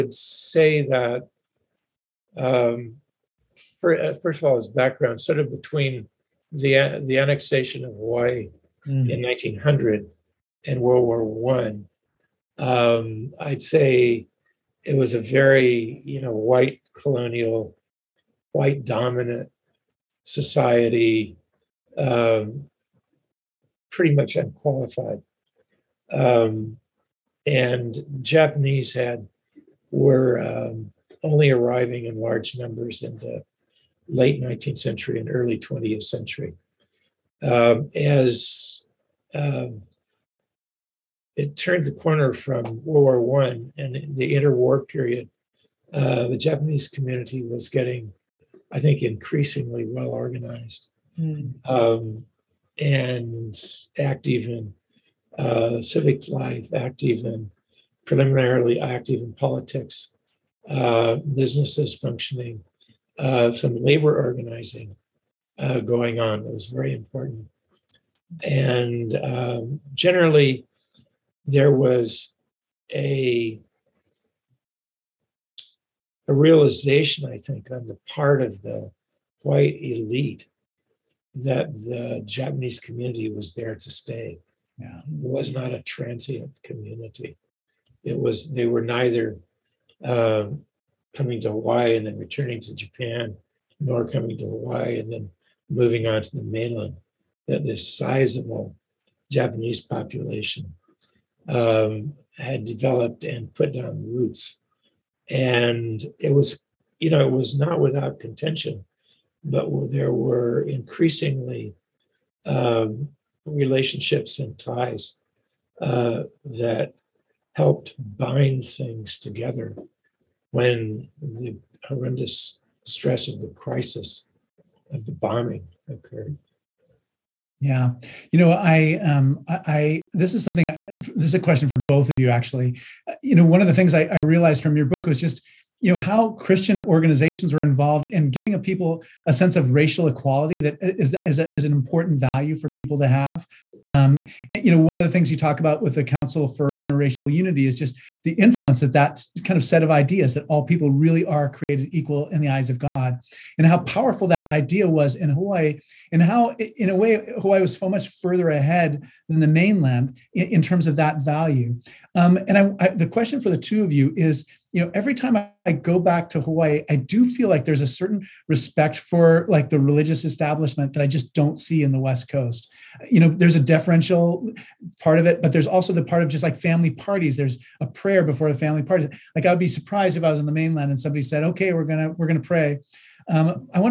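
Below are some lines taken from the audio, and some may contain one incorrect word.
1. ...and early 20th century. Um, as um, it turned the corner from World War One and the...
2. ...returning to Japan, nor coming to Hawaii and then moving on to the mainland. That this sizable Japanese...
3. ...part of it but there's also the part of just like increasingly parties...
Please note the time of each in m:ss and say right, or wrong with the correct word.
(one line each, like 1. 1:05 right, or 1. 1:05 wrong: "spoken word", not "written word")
1. 0:35 right
2. 1:32 right
3. 2:55 wrong: "family", not "increasingly".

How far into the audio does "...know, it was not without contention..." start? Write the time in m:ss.
1:47.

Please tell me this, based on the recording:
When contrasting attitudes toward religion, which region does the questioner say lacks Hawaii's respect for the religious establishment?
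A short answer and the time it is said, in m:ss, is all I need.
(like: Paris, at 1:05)
West Coast, at 2:51.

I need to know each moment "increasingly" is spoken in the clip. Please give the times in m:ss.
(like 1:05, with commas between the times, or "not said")
0:49, 1:50.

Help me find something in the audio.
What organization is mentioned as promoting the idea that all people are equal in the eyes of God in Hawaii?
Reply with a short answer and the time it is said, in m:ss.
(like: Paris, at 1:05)
Council for Interracial Unity, at 2:26.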